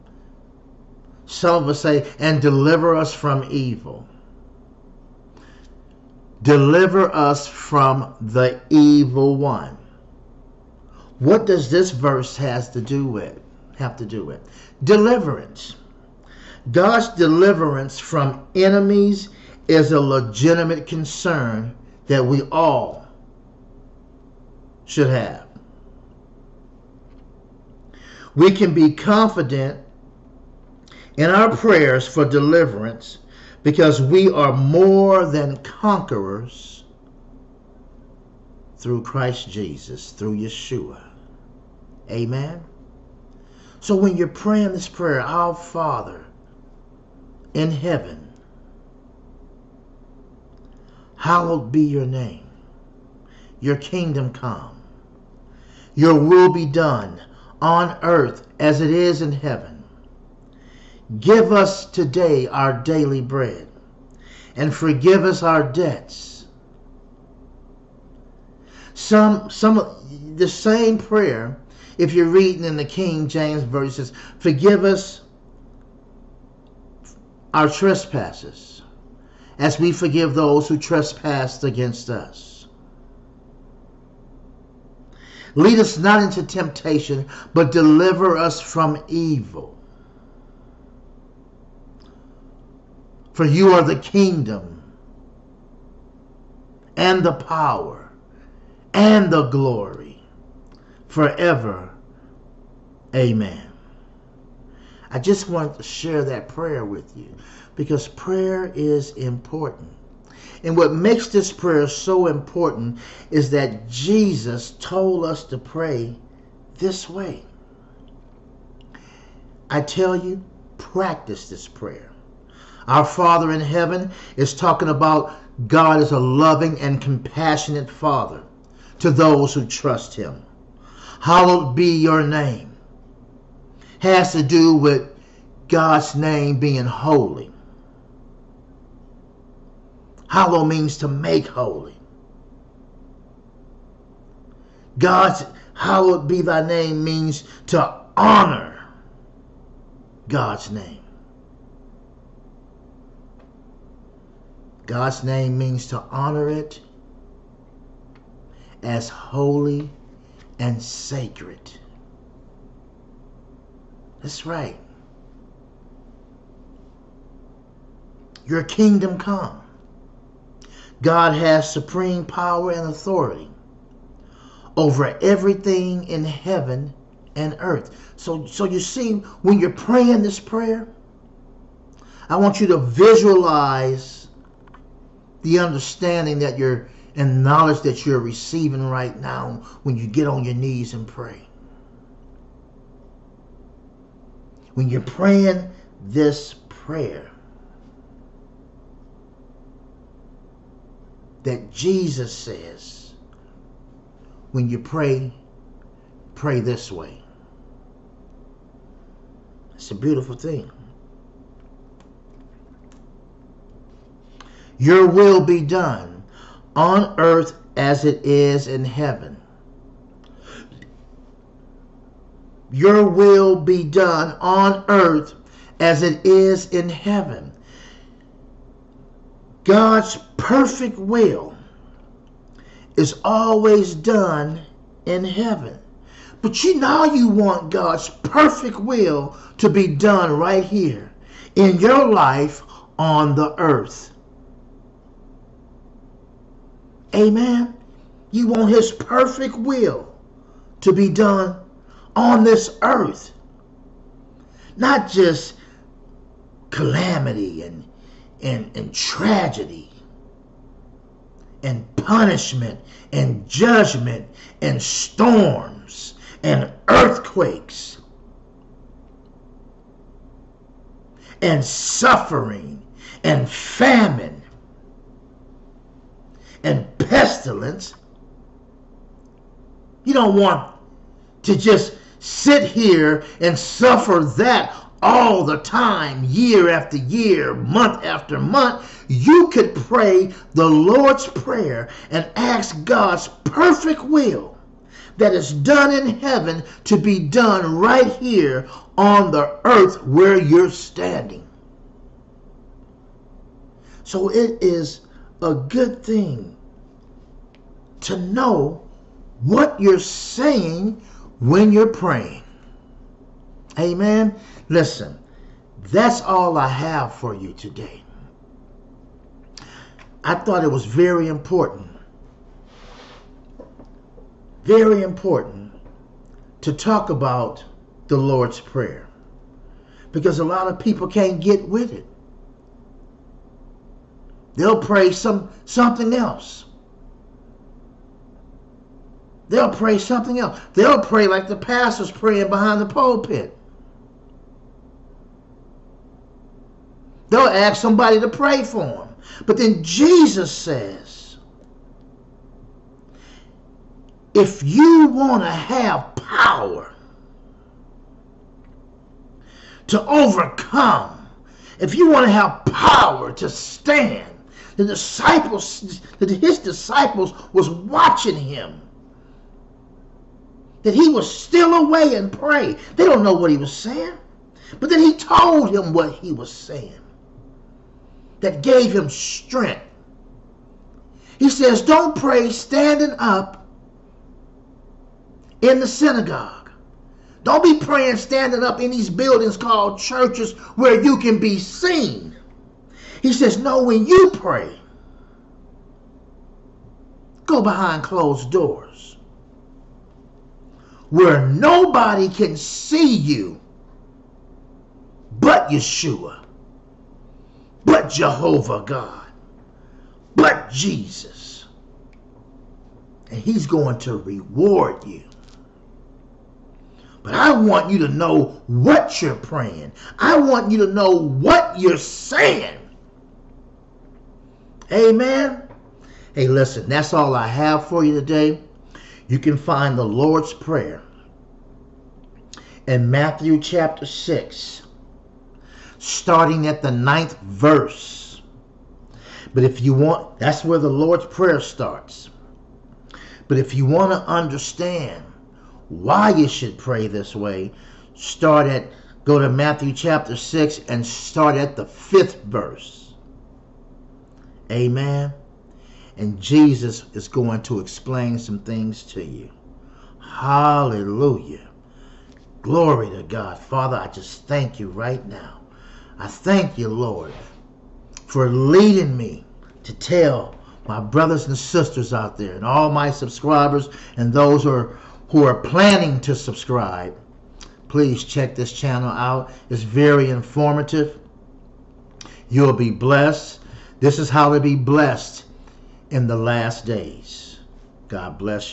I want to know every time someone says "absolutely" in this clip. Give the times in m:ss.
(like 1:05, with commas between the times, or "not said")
not said.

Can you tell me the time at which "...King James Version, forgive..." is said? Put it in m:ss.
1:12.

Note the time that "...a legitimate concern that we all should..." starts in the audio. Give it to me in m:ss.
0:19.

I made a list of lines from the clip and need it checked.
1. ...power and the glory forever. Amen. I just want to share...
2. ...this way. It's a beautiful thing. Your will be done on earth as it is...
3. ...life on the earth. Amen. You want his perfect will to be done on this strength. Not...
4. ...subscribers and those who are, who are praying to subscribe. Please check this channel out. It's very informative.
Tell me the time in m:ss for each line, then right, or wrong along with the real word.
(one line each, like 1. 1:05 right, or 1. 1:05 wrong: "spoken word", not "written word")
1. 1:37 right
2. 3:26 right
3. 4:02 wrong: "earth", not "strength"
4. 7:53 wrong: "planning", not "praying".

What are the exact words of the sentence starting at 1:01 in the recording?
Give us today our daily bread, and forgive us our debts.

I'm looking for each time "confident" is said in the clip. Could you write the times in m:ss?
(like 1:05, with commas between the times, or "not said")
0:28.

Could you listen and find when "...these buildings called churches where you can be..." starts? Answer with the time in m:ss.
6:28.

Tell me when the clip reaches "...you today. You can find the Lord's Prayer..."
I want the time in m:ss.
7:08.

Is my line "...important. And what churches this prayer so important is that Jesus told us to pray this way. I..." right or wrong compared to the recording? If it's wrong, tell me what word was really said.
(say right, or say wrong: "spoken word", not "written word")
wrong: "makes", not "churches".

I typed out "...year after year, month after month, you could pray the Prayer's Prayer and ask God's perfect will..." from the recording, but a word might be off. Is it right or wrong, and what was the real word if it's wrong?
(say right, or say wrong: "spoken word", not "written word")
wrong: "Lord", not "Prayer".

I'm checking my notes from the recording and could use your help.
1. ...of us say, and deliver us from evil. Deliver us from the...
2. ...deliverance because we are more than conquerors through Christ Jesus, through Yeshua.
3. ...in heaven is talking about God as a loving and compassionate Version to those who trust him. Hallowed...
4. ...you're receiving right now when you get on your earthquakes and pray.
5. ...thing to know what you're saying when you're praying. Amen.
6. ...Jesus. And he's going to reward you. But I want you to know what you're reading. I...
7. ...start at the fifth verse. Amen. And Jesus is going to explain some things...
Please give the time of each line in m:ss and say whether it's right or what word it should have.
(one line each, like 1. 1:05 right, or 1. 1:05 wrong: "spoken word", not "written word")
1. 0:01 right
2. 0:32 right
3. 2:03 wrong: "Father", not "Version"
4. 3:08 wrong: "knees", not "earthquakes"
5. 5:06 right
6. 6:50 wrong: "praying", not "reading"
7. 7:31 right.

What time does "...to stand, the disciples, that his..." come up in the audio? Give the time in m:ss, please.
6:03.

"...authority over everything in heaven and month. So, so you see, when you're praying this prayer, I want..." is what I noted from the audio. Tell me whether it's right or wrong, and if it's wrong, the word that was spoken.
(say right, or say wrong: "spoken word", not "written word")
wrong: "earth", not "month".